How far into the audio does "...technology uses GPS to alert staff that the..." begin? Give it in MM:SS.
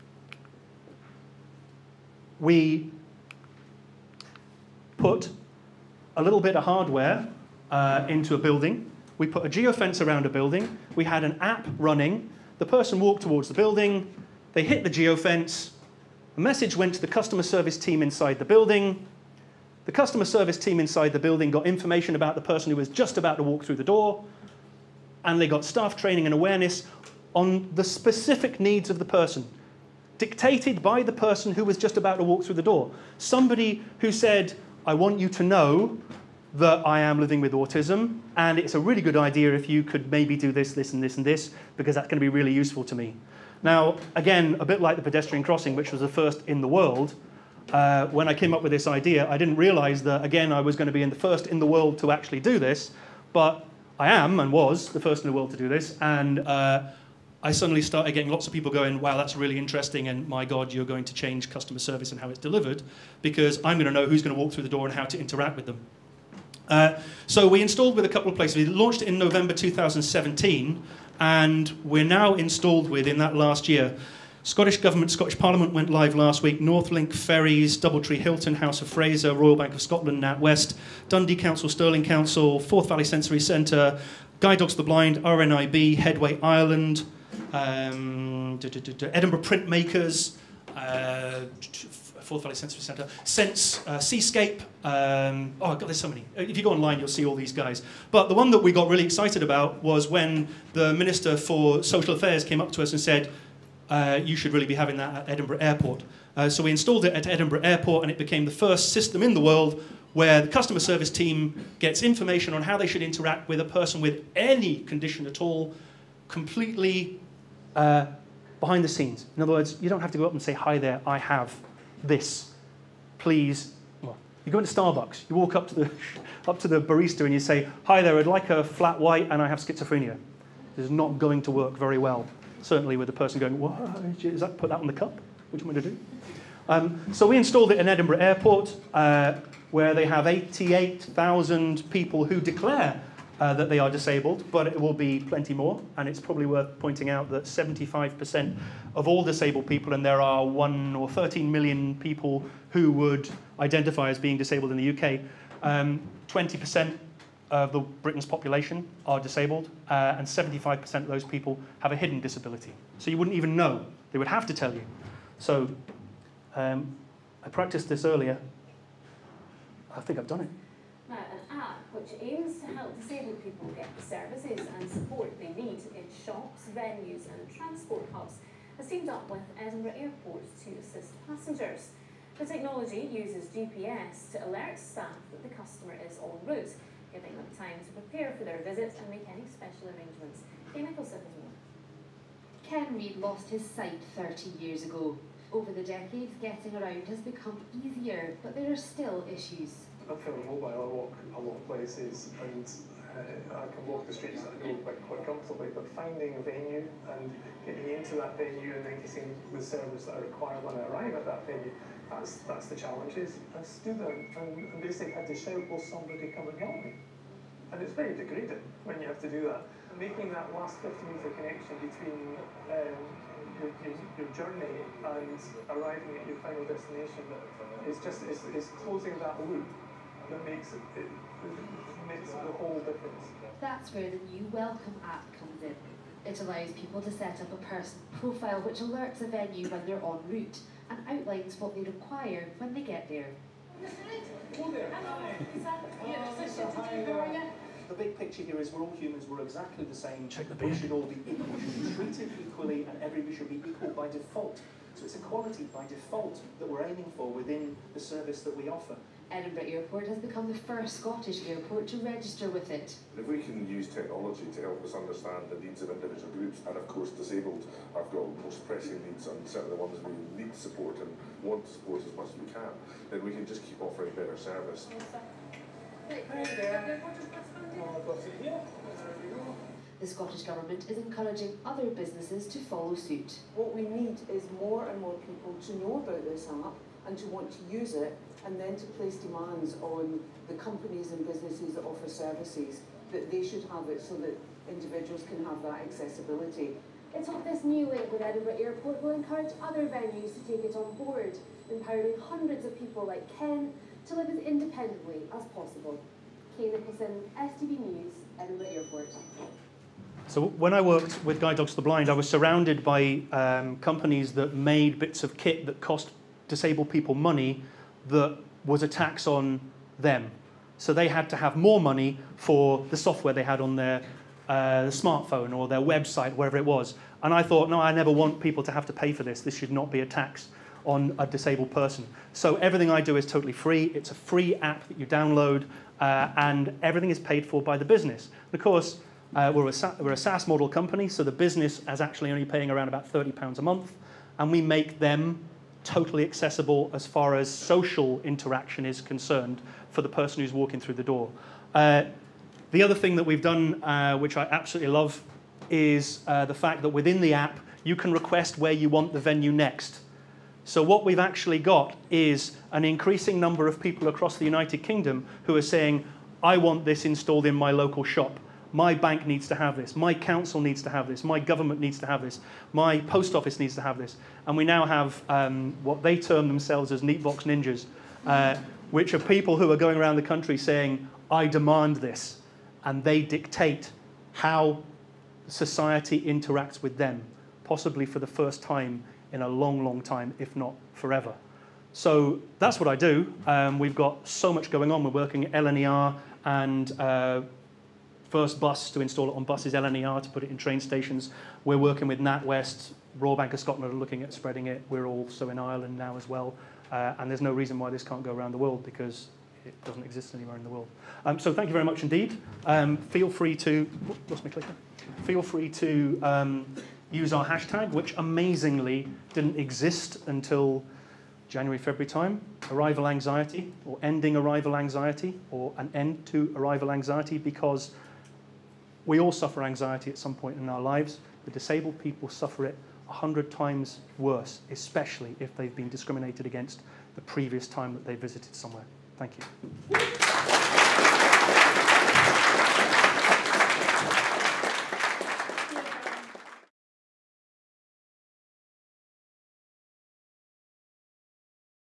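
03:02.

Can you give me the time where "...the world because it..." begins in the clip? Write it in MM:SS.
06:48.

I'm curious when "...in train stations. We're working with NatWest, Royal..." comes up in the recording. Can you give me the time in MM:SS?
06:40.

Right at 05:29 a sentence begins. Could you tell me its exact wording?
This should not be a tax on a disabled person.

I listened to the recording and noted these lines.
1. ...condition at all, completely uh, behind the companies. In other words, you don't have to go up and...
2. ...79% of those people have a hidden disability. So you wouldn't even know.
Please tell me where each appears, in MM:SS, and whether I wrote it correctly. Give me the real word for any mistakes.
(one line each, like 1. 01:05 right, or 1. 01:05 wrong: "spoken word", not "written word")
1. 01:54 wrong: "scenes", not "companies"
2. 02:40 wrong: "75", not "79".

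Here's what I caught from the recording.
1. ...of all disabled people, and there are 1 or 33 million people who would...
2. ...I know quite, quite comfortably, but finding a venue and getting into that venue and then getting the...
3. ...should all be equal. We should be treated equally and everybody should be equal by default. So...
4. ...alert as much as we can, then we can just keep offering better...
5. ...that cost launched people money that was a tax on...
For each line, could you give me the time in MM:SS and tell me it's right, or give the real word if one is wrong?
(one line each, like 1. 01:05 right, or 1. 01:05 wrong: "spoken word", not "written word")
1. 02:28 wrong: "13", not "33"
2. 03:24 right
3. 04:10 right
4. 04:31 wrong: "support", not "alert"
5. 05:15 wrong: "disabled", not "launched".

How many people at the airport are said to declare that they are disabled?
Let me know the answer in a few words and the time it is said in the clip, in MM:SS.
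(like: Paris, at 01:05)
88,000, at 02:20.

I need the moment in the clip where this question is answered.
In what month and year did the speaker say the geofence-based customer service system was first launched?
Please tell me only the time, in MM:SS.
01:09.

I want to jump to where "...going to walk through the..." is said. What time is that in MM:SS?
01:04.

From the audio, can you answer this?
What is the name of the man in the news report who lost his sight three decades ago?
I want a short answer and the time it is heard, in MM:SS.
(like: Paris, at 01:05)
Ken Reid, at 03:12.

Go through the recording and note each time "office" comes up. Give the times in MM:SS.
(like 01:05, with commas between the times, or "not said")
06:13.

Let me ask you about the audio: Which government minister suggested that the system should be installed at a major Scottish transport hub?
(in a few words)
Minister for Social Affairs.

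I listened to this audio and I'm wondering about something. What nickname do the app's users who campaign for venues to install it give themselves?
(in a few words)
Neatebox Ninjas.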